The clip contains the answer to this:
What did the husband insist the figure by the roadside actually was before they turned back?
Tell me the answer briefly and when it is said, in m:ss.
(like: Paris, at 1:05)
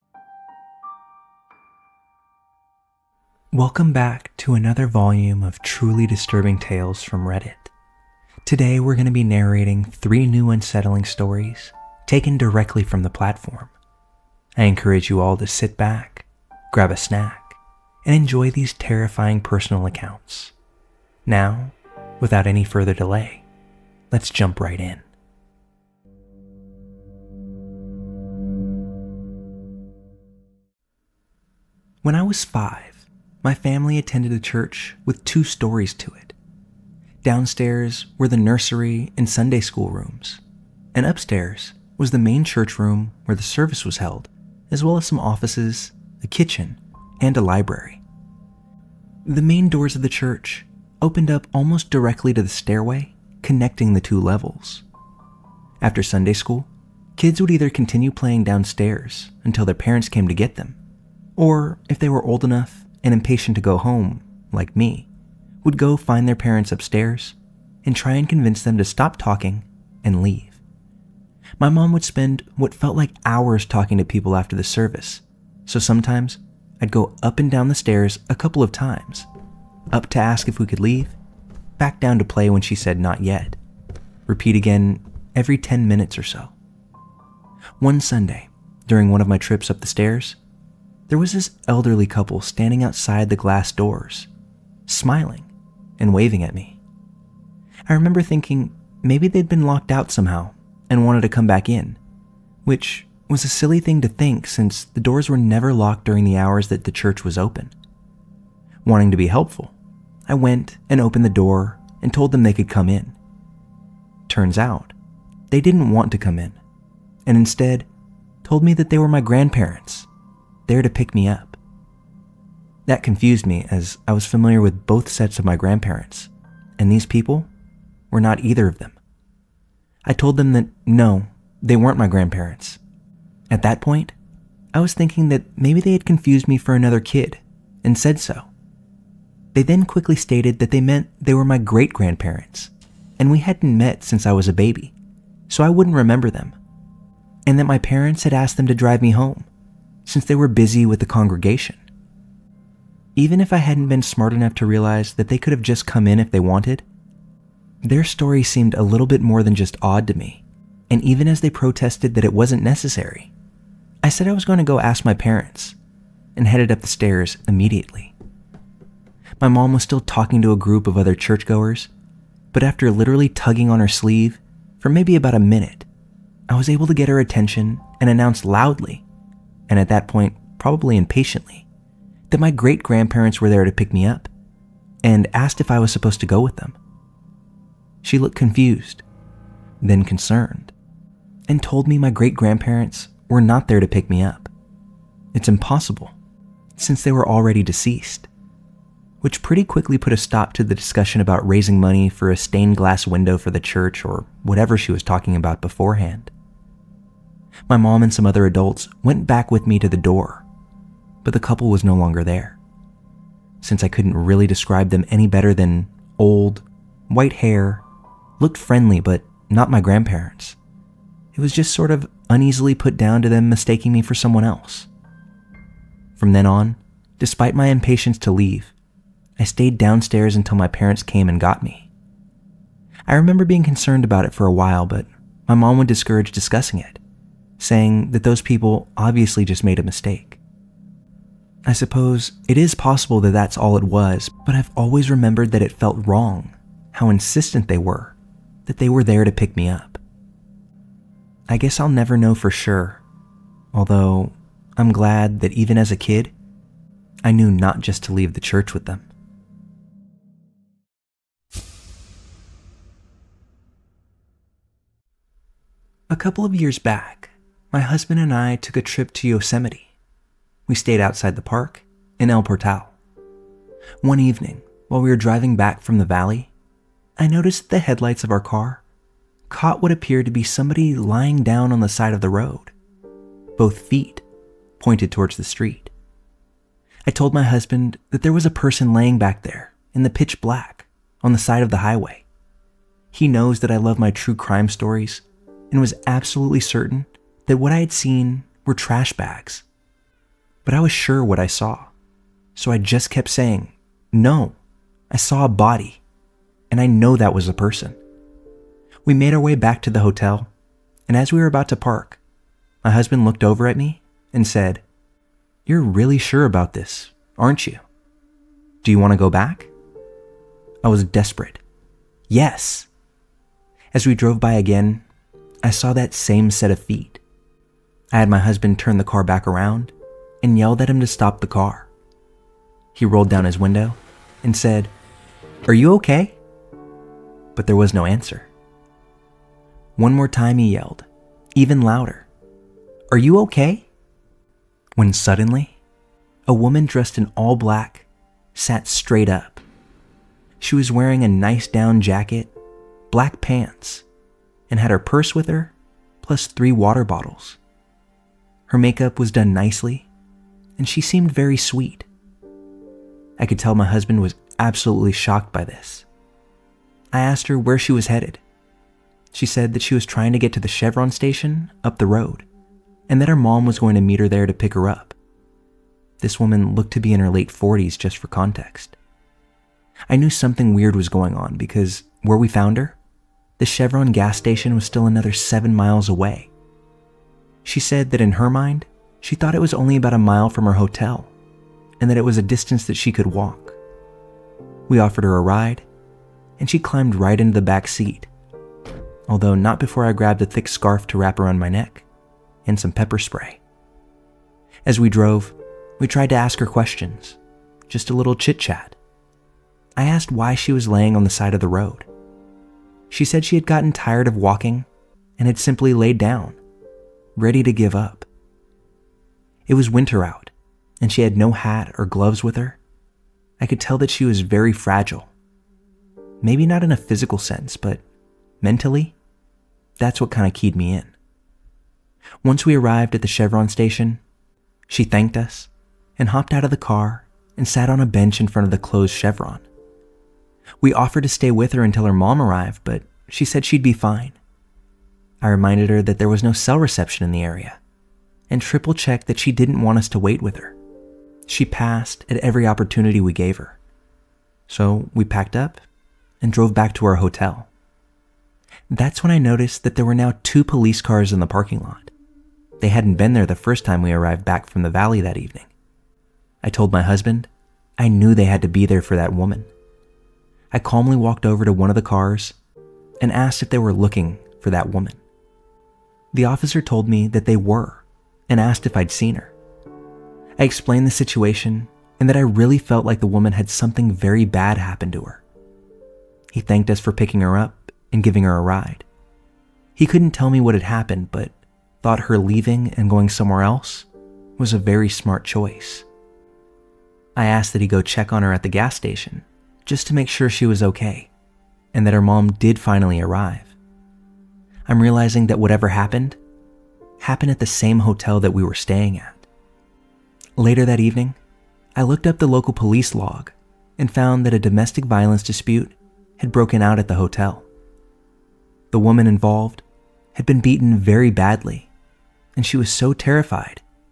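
Trash bags, at 4:58.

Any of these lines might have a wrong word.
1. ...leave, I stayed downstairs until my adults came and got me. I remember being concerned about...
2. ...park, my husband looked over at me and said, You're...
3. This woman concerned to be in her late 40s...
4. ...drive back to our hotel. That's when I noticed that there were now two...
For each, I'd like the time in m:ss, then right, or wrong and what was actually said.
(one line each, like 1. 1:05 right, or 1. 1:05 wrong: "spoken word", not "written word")
1. 3:48 wrong: "parents", not "adults"
2. 5:11 right
3. 6:16 wrong: "looked", not "concerned"
4. 7:36 wrong: "drove", not "drive".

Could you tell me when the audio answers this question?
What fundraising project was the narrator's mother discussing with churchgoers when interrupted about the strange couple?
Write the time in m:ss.
3:22.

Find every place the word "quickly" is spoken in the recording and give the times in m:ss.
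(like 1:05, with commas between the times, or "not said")
2:19, 3:19.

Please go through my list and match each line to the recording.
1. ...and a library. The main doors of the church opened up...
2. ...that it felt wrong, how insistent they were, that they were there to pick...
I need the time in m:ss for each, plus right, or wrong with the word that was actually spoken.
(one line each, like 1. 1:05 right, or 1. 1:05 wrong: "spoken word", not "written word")
1. 0:47 right
2. 4:05 right.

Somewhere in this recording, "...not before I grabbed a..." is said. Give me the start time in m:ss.
6:39.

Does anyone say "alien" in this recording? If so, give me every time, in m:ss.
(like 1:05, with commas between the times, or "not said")
not said.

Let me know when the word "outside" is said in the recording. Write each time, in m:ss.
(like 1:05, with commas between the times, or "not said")
1:32, 4:31.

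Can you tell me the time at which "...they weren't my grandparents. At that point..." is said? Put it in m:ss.
2:11.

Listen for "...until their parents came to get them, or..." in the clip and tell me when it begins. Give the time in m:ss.
0:59.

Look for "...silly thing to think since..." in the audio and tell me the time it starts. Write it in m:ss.
1:43.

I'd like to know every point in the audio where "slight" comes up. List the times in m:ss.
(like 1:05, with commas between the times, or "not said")
not said.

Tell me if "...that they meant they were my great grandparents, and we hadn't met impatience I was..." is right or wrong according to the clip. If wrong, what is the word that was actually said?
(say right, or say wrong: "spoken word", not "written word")
wrong: "since", not "impatience".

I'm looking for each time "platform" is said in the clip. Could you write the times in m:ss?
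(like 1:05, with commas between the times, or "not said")
0:13.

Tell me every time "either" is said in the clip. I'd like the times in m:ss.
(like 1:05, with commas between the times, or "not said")
0:57, 2:08.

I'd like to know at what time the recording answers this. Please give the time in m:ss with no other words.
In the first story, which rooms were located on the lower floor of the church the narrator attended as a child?
0:38.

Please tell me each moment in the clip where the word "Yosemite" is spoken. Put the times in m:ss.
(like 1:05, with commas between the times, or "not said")
4:29.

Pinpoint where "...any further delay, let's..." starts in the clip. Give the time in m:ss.
0:22.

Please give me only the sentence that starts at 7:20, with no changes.
We offered to stay with her until her mom arrived, but she said she'd be fine.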